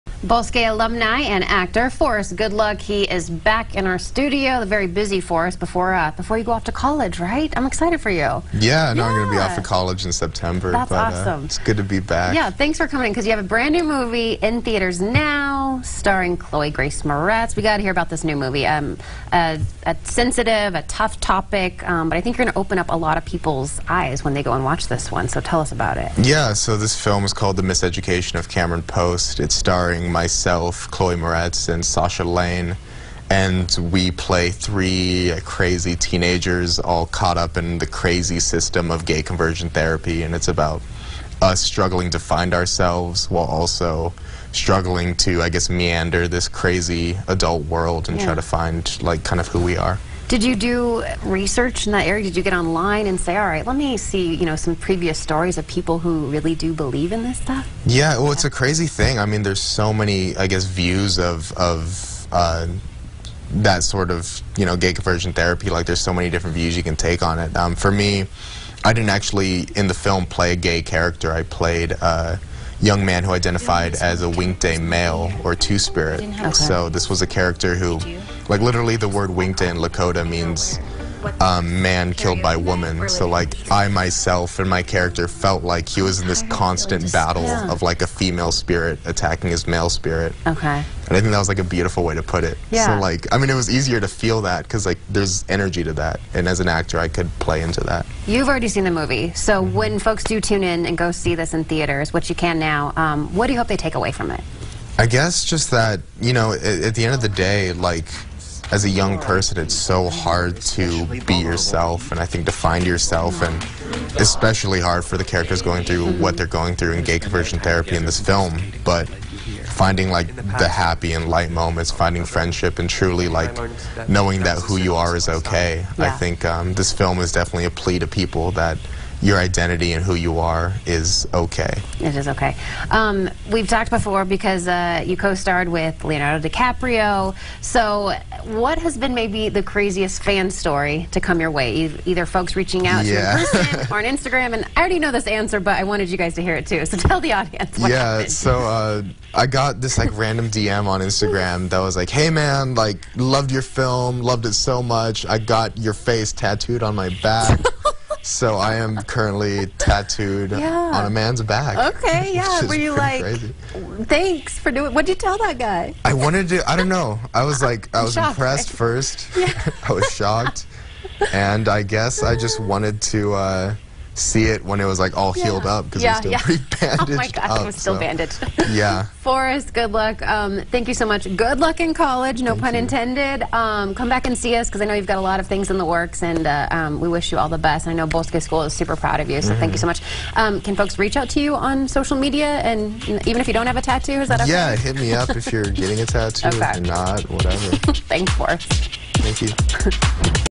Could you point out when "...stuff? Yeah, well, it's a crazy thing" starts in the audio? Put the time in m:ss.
0:57.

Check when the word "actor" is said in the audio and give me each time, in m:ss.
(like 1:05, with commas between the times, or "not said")
0:01, 1:36.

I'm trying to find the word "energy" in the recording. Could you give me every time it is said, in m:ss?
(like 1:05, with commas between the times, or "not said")
1:35.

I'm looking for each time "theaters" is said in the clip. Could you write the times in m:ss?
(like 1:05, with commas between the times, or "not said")
0:14, 1:41.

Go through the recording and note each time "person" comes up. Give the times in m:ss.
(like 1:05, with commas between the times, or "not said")
1:49, 2:23.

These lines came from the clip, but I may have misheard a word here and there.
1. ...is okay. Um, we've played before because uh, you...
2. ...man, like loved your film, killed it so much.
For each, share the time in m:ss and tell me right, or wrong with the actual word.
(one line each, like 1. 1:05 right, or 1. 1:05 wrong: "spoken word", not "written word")
1. 2:12 wrong: "talked", not "played"
2. 2:32 wrong: "loved", not "killed".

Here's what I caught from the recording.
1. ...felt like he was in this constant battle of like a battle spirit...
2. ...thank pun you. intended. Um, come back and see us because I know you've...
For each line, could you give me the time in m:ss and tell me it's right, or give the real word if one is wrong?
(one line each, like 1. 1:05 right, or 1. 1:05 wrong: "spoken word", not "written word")
1. 1:25 wrong: "female", not "battle"
2. 3:02 right.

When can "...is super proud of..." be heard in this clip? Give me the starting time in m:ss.
3:08.